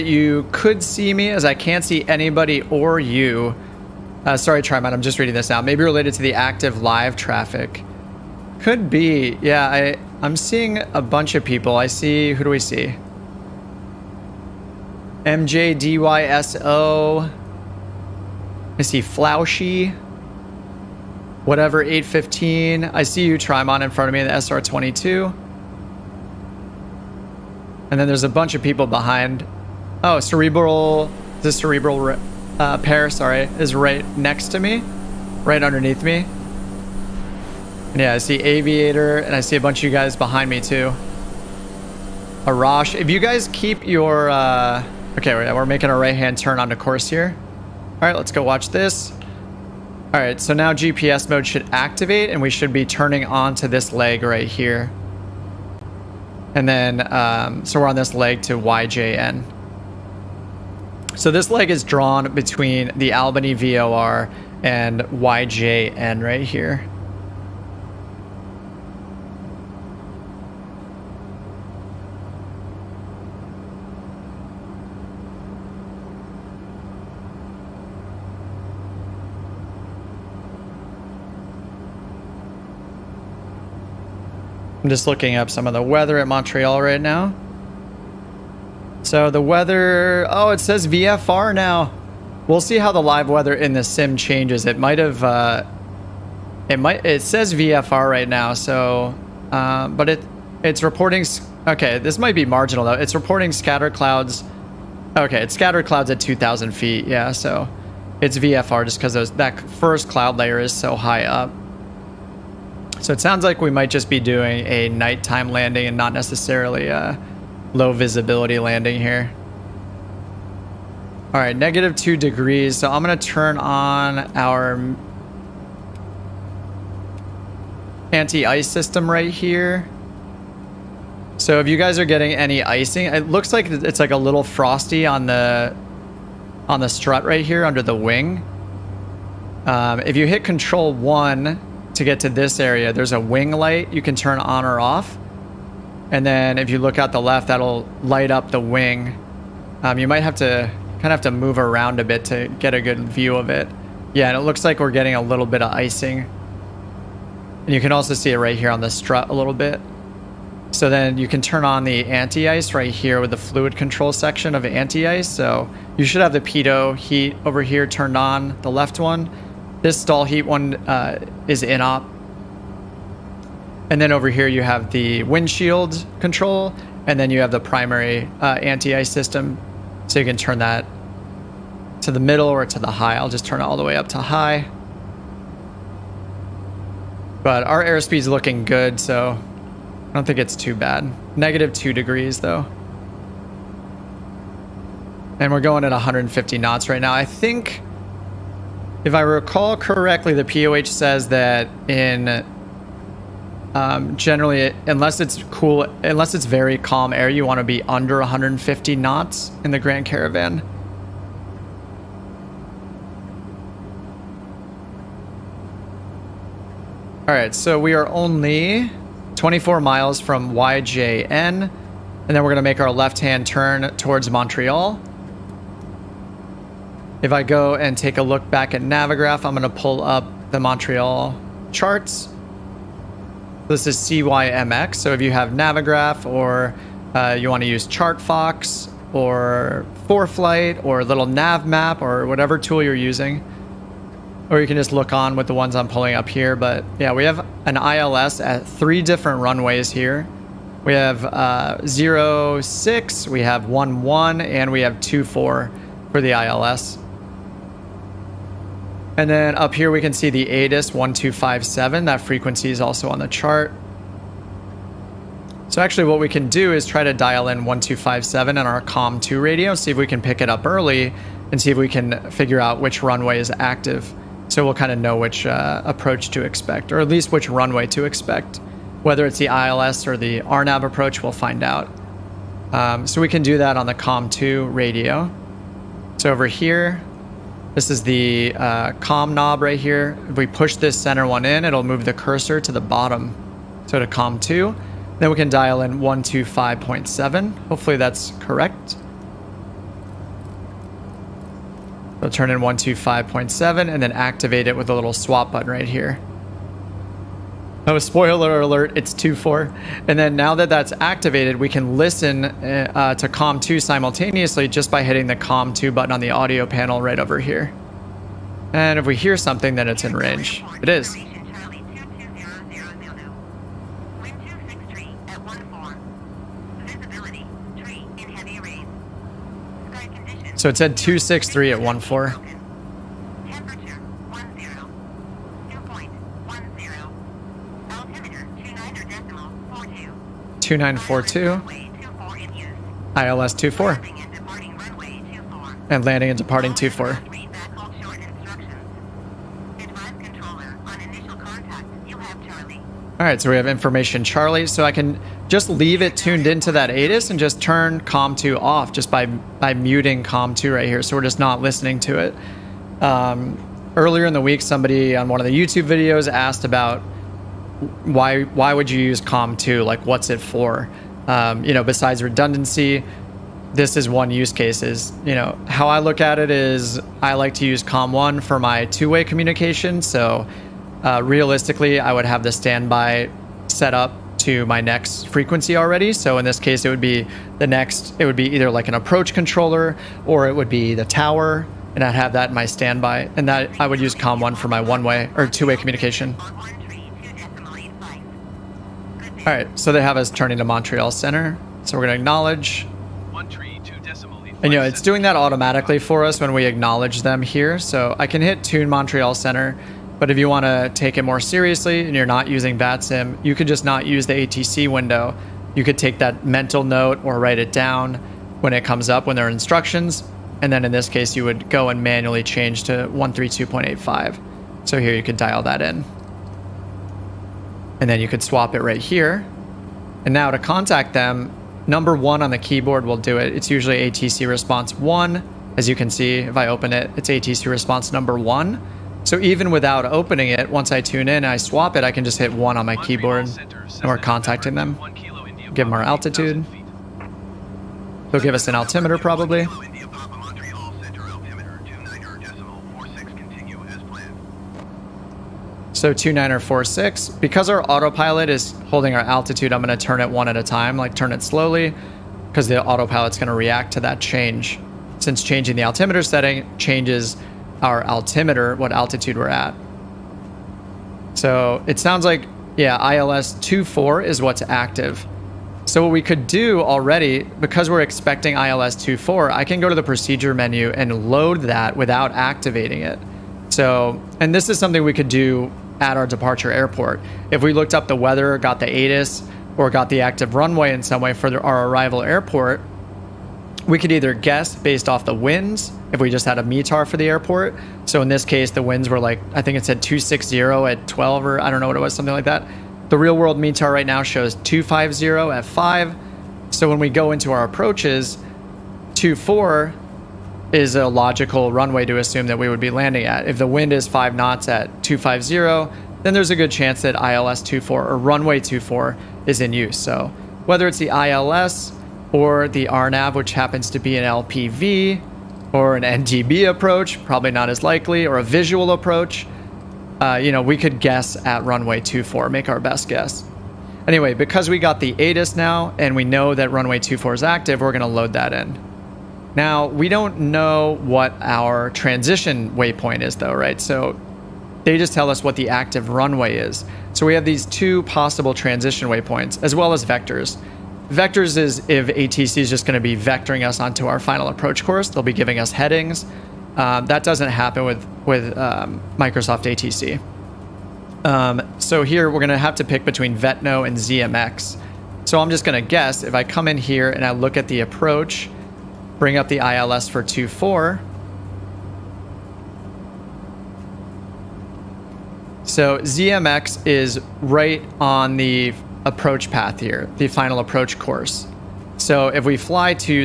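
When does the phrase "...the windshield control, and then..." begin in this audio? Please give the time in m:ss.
2:54.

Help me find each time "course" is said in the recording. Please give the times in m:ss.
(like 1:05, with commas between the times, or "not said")
0:46, 9:14, 9:40.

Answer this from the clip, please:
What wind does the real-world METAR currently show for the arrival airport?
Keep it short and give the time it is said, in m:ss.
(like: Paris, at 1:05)
250 at 5, at 8:24.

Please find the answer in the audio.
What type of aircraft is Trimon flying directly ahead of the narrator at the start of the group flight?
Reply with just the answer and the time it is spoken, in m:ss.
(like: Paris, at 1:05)
SR22, at 0:24.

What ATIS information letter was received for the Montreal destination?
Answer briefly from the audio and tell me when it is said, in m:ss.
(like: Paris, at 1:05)
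Charlie, at 5:54.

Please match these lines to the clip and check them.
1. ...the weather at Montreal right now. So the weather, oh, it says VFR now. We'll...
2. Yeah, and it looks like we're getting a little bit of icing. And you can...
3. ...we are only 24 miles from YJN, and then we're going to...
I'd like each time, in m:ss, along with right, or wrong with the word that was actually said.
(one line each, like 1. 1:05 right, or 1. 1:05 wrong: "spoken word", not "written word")
1. 1:25 right
2. 2:34 right
3. 3:37 right.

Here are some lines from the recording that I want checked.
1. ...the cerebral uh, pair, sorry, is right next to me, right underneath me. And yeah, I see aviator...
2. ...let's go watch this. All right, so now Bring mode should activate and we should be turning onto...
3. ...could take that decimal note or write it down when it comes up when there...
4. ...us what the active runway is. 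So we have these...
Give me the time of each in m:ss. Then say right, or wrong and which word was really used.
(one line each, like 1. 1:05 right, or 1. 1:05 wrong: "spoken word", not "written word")
1. 0:31 right
2. 0:48 wrong: "GPS", not "Bring"
3. 6:55 wrong: "mental", not "decimal"
4. 9:05 right.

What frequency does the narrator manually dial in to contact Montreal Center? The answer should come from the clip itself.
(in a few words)
132.85.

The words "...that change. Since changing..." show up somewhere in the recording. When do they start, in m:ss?
7:44.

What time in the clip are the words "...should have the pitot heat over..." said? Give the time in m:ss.
2:46.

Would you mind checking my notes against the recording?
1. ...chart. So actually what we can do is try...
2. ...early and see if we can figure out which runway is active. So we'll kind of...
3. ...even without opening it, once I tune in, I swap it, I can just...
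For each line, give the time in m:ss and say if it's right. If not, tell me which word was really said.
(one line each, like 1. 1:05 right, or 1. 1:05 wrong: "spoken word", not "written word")
1. 4:23 right
2. 4:30 right
3. 7:19 right.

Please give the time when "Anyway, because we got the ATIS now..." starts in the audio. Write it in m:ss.
8:54.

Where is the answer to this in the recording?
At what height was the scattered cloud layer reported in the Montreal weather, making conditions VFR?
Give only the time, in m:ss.
1:46.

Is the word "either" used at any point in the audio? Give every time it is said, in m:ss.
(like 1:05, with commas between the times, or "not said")
6:28, 8:14.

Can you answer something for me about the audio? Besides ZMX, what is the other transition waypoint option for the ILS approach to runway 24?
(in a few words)
Vetno.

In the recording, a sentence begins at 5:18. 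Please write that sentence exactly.
And if we hear something, then it's in range.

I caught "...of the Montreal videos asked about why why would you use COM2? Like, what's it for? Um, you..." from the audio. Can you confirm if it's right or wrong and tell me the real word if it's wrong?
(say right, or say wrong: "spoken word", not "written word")
wrong: "YouTube", not "Montreal".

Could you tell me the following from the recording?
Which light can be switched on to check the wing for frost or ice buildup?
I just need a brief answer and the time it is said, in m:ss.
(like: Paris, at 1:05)
wing light, at 2:23.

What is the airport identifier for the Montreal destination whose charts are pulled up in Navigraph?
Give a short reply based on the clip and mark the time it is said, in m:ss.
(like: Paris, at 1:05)
CYMX, at 3:53.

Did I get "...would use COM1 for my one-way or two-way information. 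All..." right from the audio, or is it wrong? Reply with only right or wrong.
wrong.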